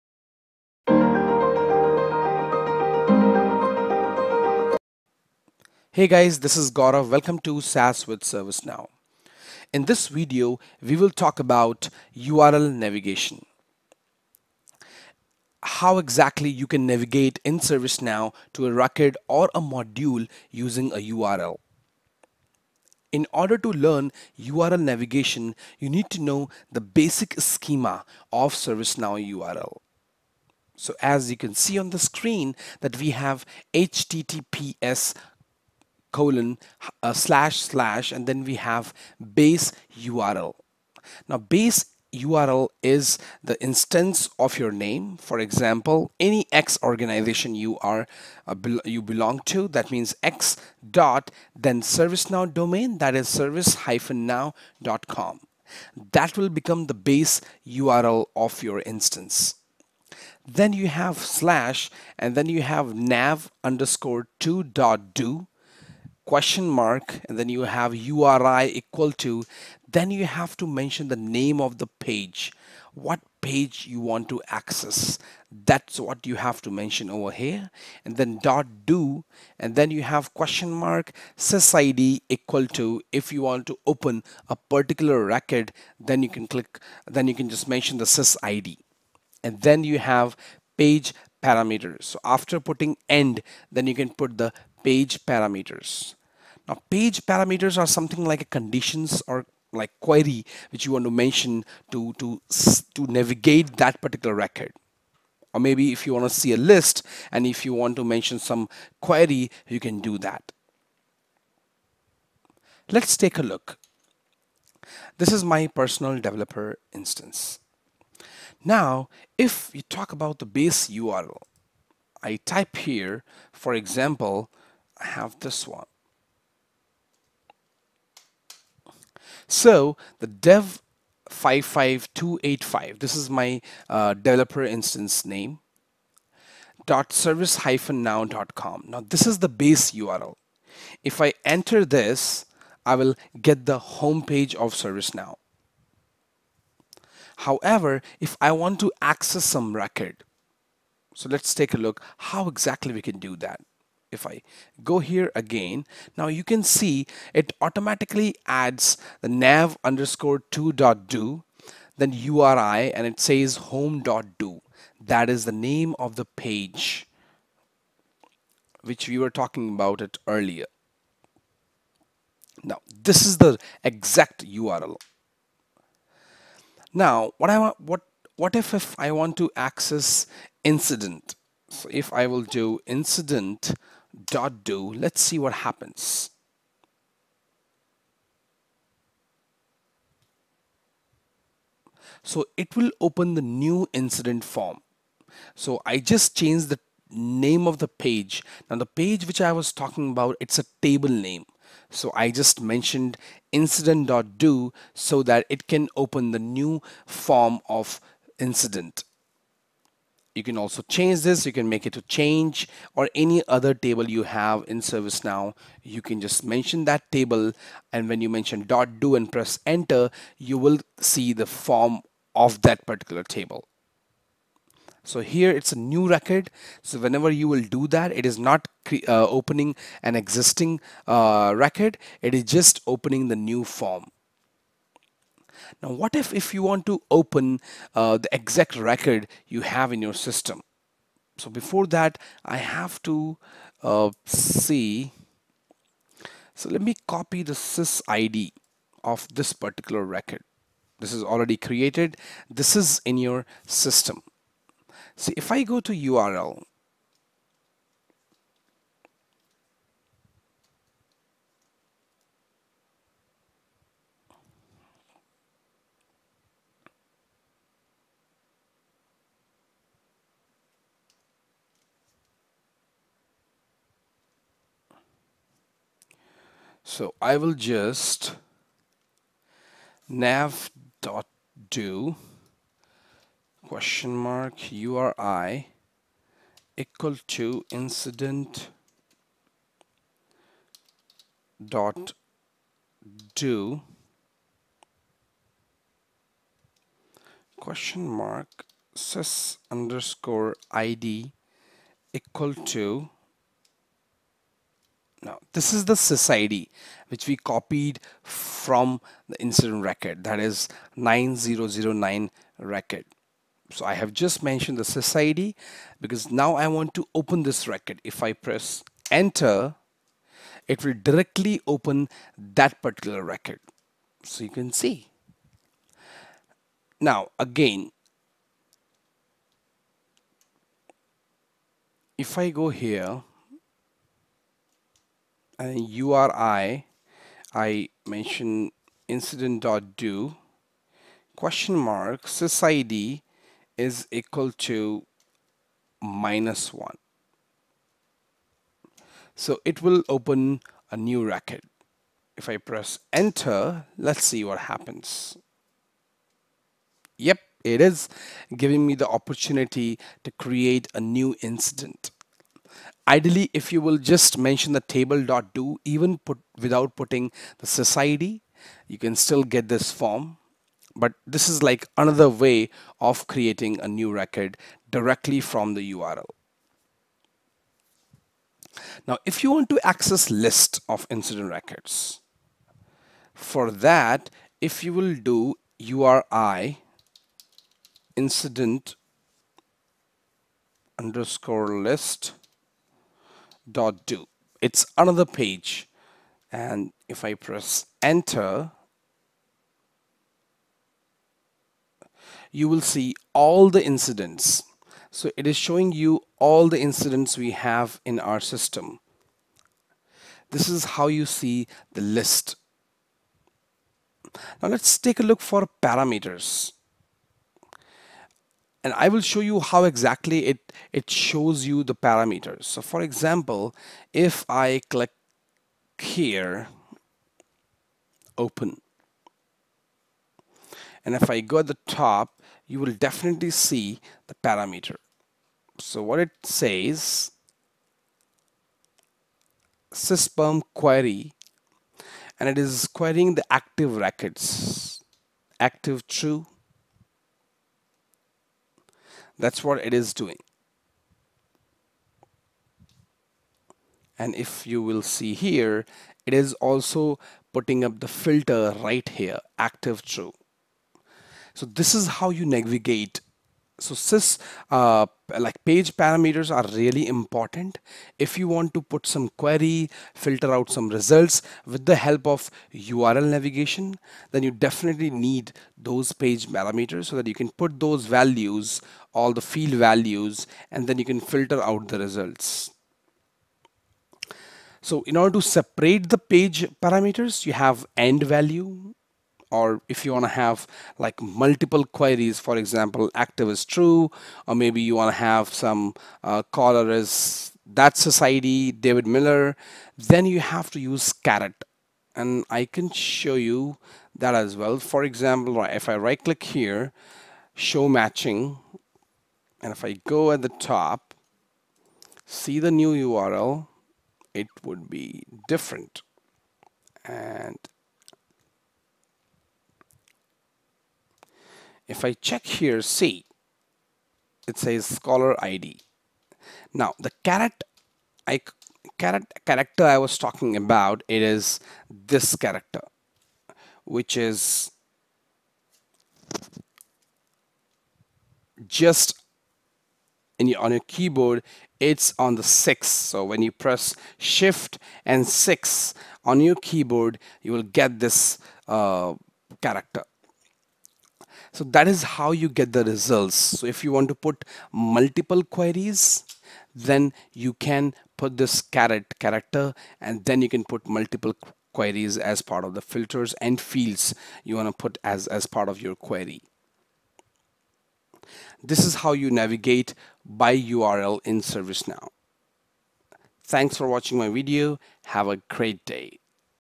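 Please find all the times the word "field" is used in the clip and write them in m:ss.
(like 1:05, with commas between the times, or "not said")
7:59, 9:23.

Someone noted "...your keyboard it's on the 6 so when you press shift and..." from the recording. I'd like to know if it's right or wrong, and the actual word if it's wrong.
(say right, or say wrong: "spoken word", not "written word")
right.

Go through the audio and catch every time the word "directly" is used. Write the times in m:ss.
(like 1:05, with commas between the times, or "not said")
5:21, 6:14.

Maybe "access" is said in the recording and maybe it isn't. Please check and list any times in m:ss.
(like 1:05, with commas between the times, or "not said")
1:14, 2:29, 2:59, 6:19.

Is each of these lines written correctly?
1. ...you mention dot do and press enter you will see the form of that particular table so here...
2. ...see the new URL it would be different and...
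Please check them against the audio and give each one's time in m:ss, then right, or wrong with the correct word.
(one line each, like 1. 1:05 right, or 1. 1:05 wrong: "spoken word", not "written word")
1. 3:38 right
2. 8:32 right.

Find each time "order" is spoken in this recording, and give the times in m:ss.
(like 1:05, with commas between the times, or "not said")
0:23, 8:05.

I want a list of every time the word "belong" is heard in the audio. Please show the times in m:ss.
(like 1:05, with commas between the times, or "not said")
0:49.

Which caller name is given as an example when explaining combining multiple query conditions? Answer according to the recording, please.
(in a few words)
David Miller.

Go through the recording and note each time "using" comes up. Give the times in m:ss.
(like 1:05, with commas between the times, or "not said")
0:20.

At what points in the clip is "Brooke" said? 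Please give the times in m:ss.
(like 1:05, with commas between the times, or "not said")
not said.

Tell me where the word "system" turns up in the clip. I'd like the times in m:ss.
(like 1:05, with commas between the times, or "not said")
4:00, 4:13, 6:48.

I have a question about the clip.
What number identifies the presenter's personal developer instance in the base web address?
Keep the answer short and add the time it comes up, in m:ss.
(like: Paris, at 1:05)
55285, at 2:11.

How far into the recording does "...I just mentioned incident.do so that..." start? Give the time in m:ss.
3:22.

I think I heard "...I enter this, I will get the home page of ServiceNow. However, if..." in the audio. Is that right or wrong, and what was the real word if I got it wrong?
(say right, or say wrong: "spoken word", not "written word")
right.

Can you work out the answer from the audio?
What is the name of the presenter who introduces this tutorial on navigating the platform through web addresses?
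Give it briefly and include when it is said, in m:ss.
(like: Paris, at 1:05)
Gaurav, at 0:06.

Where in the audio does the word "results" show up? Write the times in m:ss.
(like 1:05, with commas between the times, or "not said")
7:50, 8:02, 9:12.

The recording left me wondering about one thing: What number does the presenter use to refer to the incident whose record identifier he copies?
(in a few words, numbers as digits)
9009.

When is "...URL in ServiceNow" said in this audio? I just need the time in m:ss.
9:30.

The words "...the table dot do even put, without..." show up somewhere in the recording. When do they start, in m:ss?
6:04.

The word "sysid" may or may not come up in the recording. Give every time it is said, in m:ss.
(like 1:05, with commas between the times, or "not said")
1:21, 1:28, 5:42.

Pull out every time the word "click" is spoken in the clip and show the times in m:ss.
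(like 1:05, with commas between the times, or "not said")
1:26, 7:04, 8:26.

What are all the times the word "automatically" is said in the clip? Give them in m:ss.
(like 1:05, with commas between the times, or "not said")
2:37.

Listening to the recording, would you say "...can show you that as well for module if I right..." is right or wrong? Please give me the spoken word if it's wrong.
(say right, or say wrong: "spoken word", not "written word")
wrong: "example", not "module".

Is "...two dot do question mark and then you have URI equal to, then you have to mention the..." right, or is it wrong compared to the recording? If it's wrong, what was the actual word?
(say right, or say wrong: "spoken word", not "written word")
right.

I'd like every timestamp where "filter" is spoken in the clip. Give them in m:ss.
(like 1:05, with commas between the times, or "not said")
7:38, 7:50, 8:01, 9:22.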